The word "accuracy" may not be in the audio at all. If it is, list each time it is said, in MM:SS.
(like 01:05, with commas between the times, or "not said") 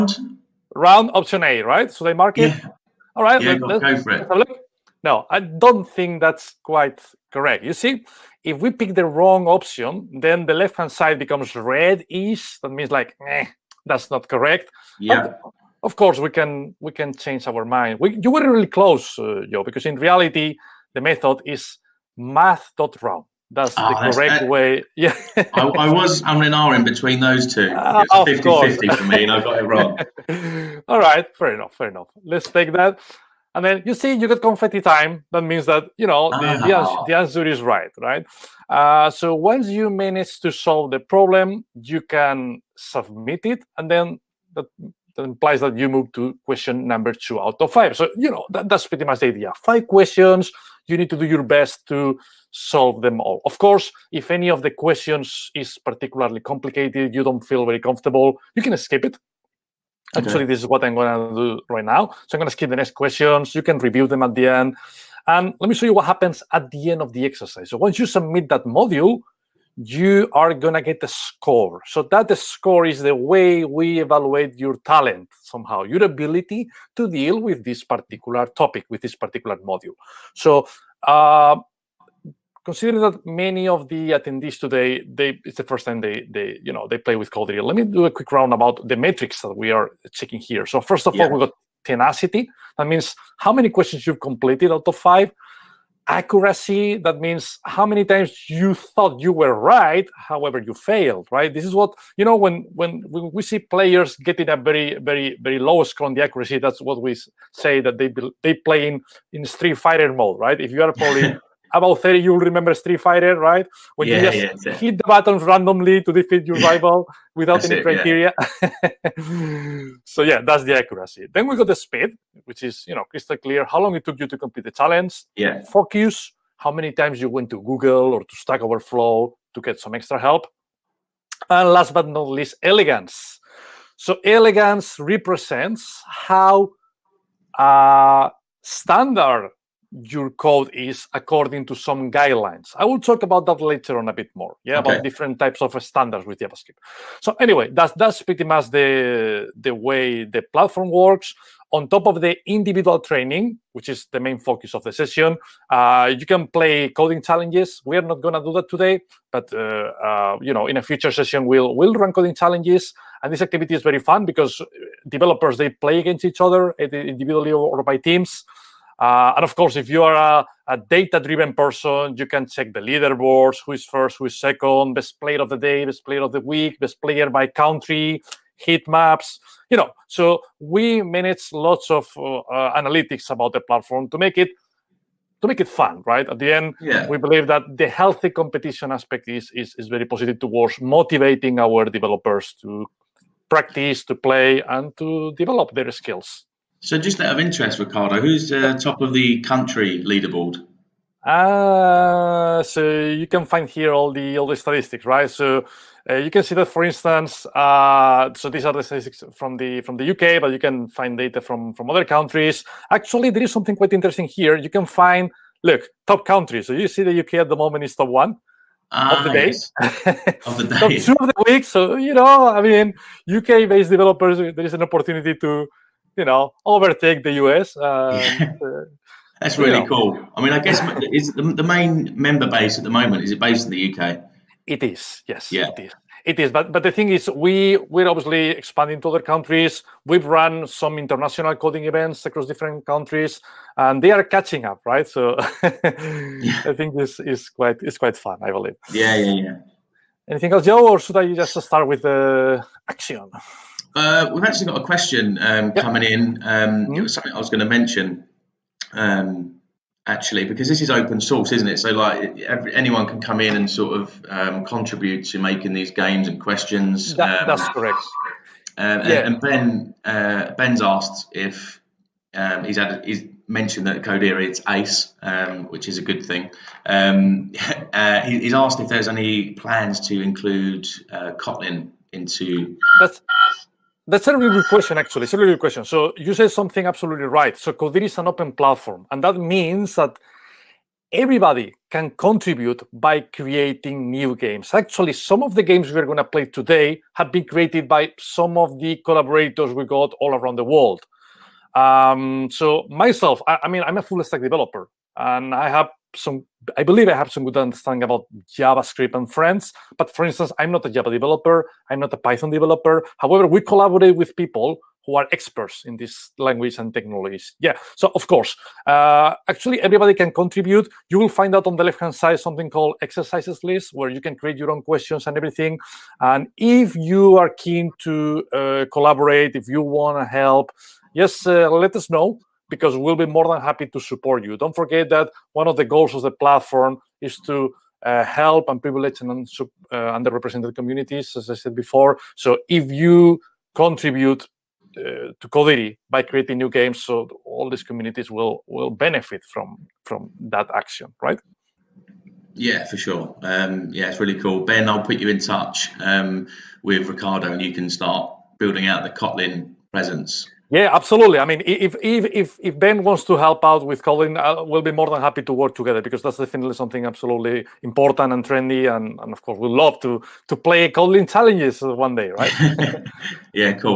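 01:36, 01:46, 02:00.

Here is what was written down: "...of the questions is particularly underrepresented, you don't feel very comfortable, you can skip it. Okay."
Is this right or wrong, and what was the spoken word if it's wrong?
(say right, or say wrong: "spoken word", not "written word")
wrong: "complicated", not "underrepresented".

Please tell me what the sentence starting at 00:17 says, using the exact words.
We, you were really close, uh, Joe, because in reality, the method is math.round.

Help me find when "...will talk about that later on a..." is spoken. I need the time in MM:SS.
02:22.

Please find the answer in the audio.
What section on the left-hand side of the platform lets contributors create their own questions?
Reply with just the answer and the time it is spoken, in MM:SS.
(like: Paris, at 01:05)
Exercises list, at 05:23.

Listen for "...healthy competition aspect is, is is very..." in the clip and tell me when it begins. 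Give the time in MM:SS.
03:07.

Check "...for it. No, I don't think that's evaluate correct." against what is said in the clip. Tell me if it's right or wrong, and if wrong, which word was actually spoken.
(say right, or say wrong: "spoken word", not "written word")
wrong: "quite", not "evaluate".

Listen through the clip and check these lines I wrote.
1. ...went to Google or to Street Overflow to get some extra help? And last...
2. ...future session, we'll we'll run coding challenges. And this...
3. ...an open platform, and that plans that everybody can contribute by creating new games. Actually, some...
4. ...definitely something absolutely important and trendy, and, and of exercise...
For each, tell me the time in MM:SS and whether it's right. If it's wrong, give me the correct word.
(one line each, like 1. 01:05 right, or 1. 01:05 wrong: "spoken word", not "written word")
1. 02:07 wrong: "Stack", not "Street"
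2. 02:40 right
3. 04:48 wrong: "means", not "plans"
4. 06:06 wrong: "course", not "exercise".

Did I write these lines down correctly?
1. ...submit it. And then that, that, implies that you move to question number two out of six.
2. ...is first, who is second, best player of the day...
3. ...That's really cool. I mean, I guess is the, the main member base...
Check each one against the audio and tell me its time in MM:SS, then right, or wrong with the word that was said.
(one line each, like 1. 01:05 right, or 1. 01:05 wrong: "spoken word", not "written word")
1. 00:42 wrong: "five", not "six"
2. 02:53 right
3. 03:49 right.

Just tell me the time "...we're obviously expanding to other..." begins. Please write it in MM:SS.
03:57.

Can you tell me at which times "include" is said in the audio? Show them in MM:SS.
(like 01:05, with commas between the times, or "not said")
04:40.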